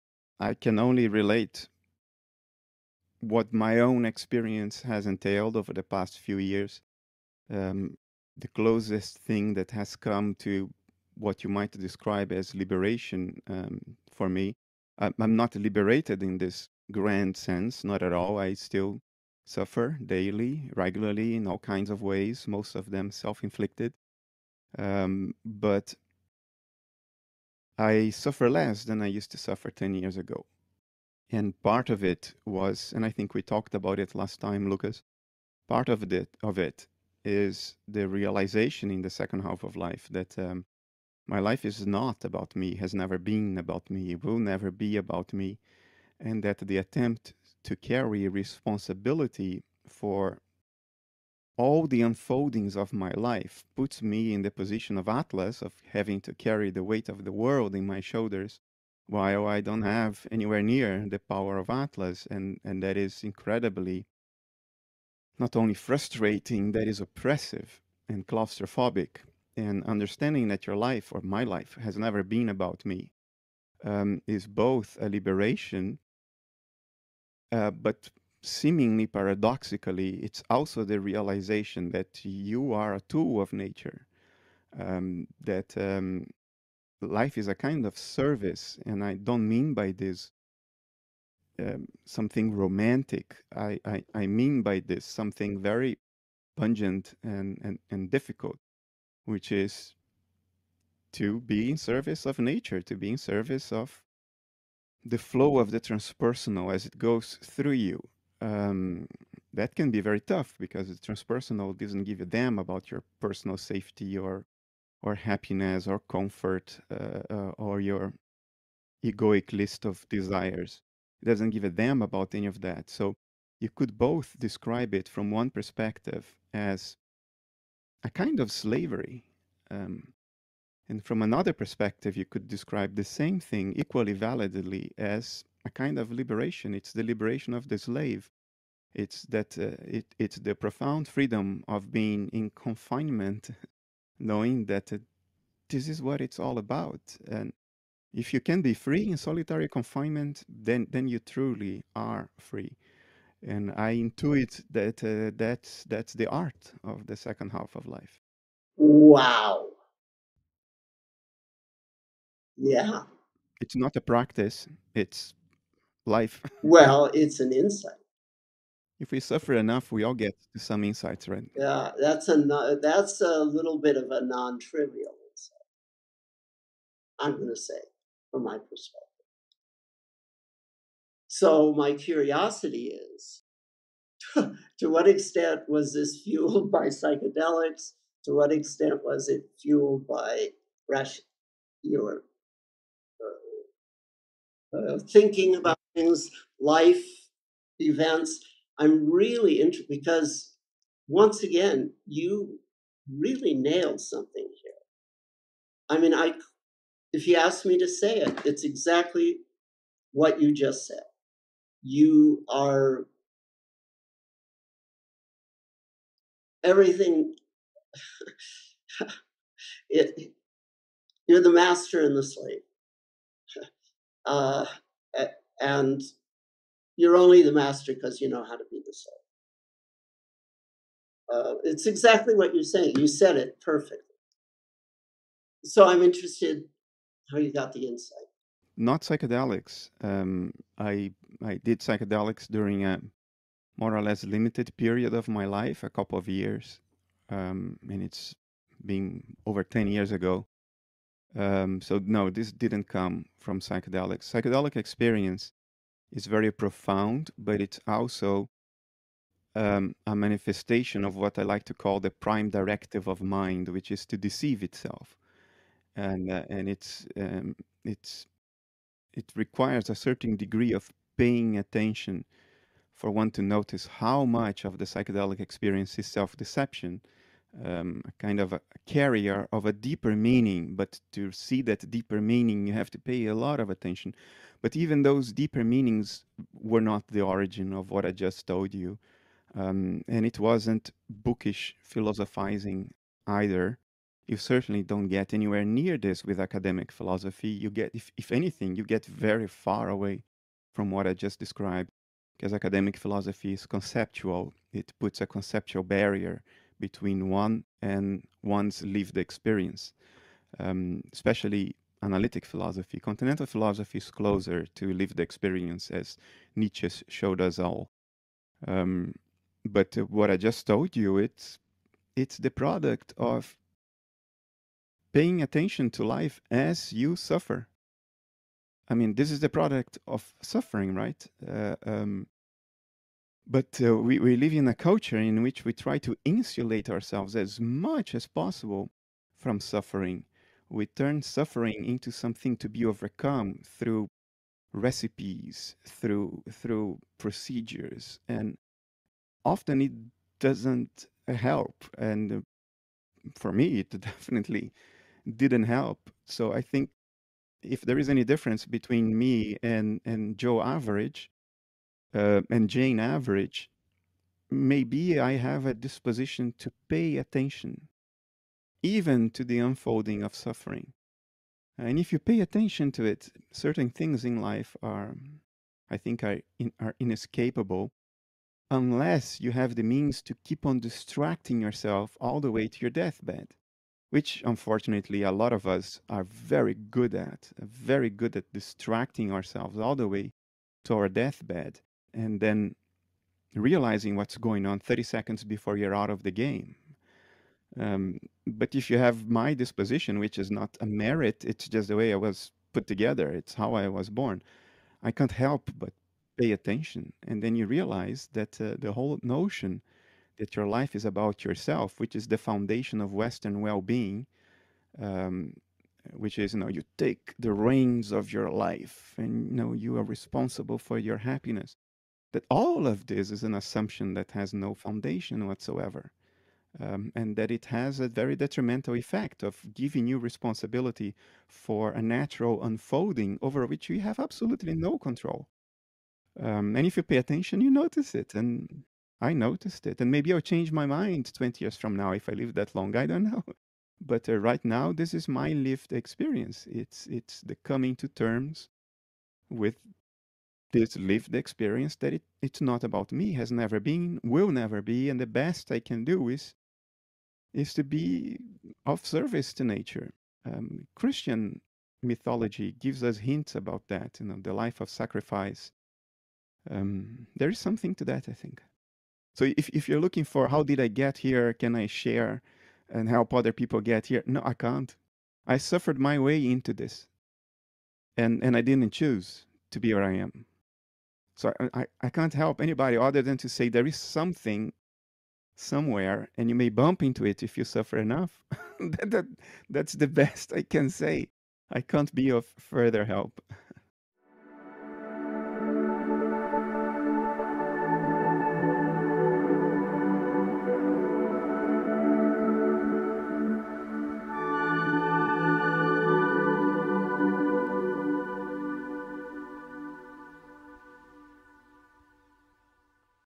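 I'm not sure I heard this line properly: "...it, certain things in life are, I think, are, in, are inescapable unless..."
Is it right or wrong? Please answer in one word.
right.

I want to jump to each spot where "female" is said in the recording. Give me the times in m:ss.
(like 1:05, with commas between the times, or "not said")
not said.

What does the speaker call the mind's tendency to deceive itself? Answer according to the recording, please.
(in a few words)
Prime directive of mind.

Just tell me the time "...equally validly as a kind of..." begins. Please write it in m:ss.
2:13.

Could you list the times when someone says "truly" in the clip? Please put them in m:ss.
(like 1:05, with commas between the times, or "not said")
2:31.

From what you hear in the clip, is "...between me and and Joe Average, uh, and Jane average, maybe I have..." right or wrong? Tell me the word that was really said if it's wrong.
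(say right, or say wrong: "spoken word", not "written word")
right.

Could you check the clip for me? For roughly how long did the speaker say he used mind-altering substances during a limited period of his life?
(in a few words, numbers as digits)
A couple of years.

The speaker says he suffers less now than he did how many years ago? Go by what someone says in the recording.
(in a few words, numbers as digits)
10.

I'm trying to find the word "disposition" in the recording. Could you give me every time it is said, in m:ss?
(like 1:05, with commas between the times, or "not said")
6:05, 6:39.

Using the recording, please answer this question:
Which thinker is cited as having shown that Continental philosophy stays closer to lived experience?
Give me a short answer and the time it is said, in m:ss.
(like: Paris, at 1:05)
Nietzsche, at 5:16.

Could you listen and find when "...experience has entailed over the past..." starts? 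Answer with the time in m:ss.
0:04.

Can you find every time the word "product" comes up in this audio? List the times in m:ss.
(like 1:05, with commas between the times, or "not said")
5:22, 5:29.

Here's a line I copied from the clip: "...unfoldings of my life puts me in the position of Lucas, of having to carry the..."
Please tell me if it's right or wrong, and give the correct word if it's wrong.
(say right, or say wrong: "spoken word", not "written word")
wrong: "Atlas", not "Lucas".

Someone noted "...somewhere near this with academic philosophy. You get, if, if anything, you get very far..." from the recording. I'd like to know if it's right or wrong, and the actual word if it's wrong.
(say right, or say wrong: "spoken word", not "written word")
wrong: "anywhere", not "somewhere".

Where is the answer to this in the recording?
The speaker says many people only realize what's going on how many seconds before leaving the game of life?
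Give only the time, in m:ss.
6:34.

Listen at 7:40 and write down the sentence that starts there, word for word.
Um, Christian mythology gives us hints about that, you know, the life of sacrifice.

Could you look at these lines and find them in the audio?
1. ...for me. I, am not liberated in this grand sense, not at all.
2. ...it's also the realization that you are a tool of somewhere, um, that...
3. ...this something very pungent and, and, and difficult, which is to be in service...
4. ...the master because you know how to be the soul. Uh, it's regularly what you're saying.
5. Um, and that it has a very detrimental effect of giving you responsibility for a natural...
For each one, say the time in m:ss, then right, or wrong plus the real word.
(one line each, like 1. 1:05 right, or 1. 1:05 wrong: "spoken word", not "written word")
1. 0:14 right
2. 1:20 wrong: "nature", not "somewhere"
3. 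1:34 right
4. 3:47 wrong: "exactly", not "regularly"
5. 7:06 right.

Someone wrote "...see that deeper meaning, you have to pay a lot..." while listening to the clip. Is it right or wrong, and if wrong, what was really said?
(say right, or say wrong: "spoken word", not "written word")
right.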